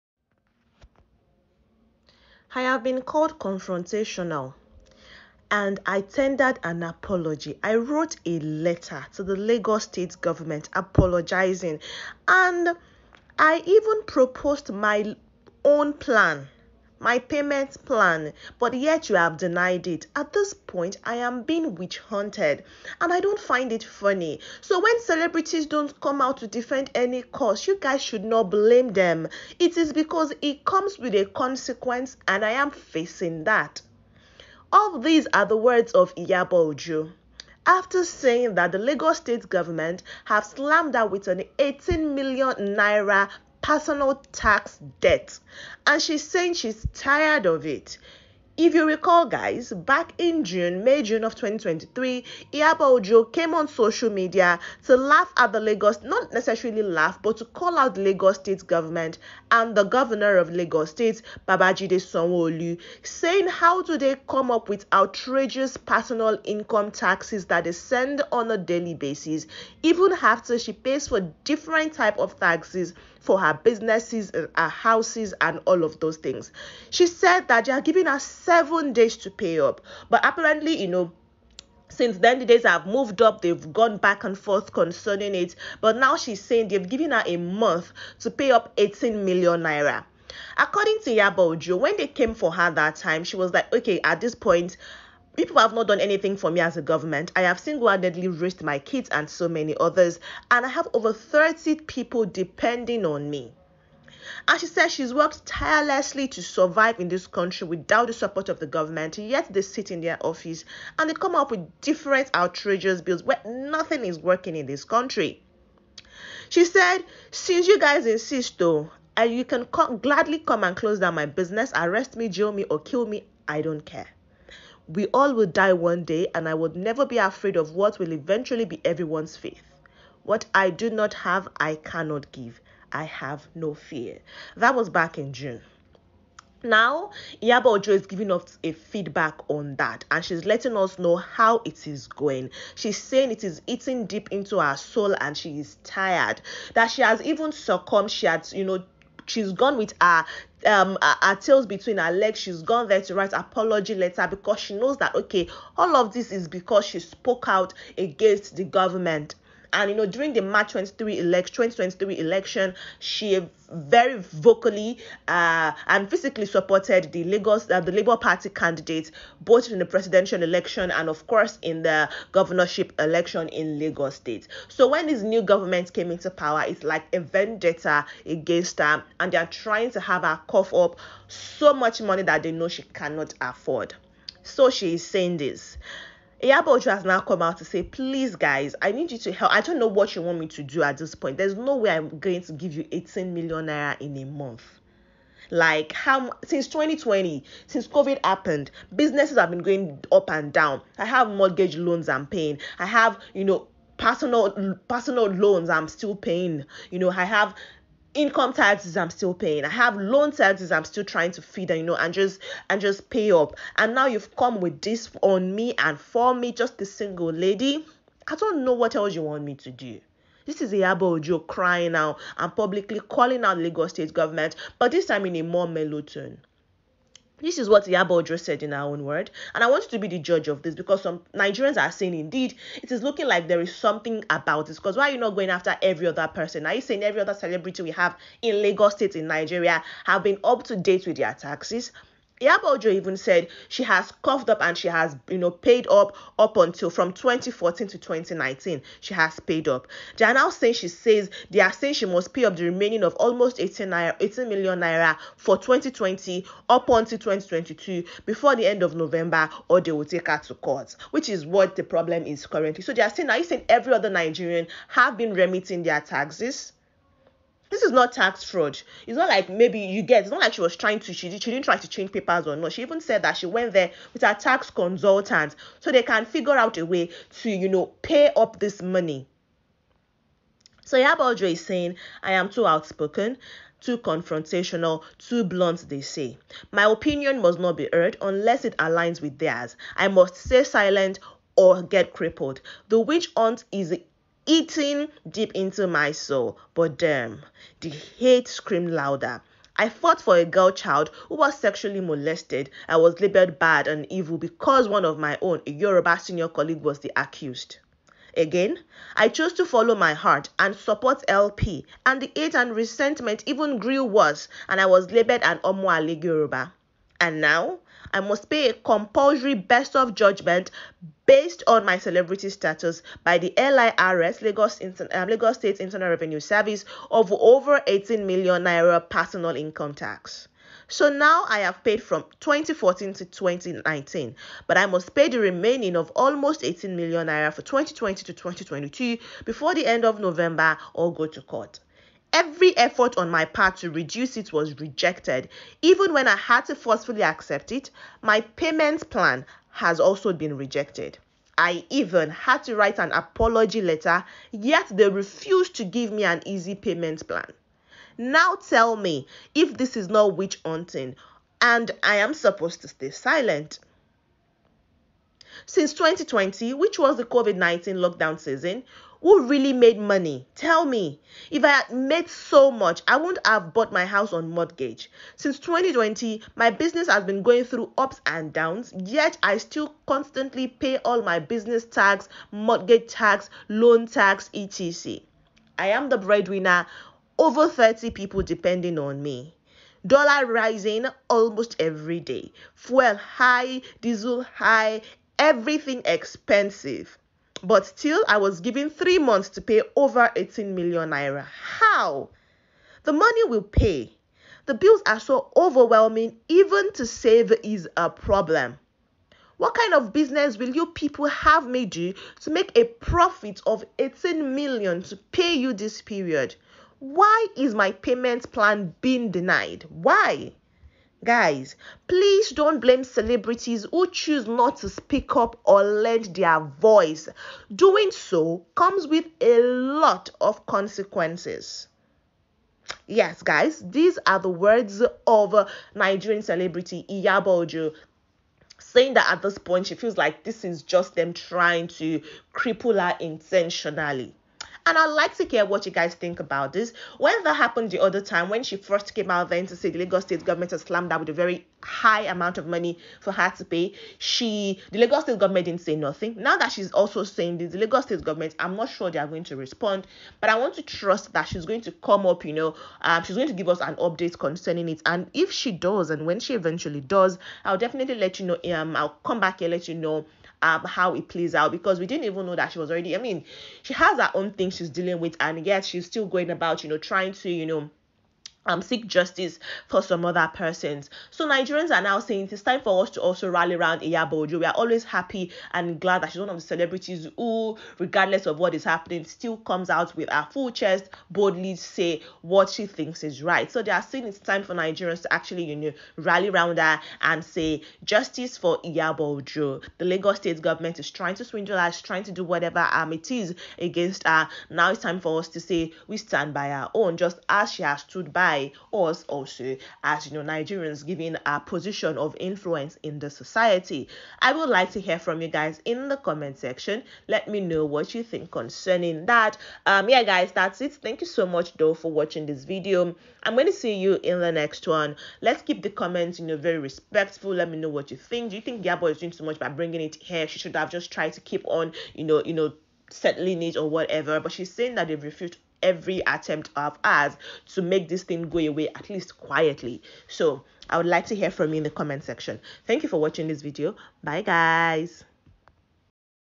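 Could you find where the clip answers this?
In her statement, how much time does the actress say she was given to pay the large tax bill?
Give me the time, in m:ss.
6:38.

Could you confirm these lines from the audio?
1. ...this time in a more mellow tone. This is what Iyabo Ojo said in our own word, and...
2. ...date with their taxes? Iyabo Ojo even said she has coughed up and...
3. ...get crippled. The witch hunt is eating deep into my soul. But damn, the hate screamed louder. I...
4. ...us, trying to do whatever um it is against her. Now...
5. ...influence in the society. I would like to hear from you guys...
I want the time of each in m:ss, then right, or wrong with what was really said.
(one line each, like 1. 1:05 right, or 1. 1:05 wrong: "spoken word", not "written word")
1. 3:44 right
2. 4:00 right
3. 4:51 right
4. 8:21 right
5. 8:32 right.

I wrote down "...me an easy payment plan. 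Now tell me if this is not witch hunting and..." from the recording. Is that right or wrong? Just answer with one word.
right.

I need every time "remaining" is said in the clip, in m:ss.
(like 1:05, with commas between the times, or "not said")
4:12, 5:35.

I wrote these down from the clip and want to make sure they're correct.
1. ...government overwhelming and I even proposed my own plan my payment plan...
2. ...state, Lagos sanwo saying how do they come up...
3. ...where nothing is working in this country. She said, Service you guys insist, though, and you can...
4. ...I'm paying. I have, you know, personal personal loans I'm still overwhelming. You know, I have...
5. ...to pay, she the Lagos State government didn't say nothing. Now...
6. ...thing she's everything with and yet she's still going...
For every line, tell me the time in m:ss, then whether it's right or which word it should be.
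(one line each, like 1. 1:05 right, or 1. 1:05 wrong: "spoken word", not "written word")
1. 0:10 wrong: "apologizing", not "overwhelming"
2. 1:00 wrong: "Babajide", not "Lagos"
3. 1:53 wrong: "Since", not "Service"
4. 3:22 wrong: "paying", not "overwhelming"
5. 7:33 right
6. 7:54 wrong: "dealing", not "everything".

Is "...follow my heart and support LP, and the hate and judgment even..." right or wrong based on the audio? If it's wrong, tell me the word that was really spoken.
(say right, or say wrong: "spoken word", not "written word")
wrong: "resentment", not "judgment".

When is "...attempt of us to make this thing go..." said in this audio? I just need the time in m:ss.
8:56.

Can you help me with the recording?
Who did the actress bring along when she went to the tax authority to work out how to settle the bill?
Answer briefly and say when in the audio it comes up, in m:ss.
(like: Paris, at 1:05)
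her tax consultant, at 4:34.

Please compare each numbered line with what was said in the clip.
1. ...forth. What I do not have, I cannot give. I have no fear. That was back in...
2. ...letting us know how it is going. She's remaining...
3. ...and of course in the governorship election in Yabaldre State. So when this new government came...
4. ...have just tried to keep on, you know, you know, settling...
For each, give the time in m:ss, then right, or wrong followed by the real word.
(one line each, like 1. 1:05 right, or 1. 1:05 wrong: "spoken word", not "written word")
1. 2:09 wrong: "faith", not "forth"
2. 2:20 wrong: "saying", not "remaining"
3. 2:50 wrong: "Lagos", not "Yabaldre"
4. 8:50 right.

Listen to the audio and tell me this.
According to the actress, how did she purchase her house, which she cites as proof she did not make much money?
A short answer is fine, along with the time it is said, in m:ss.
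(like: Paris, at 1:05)
on mortgage, at 6:14.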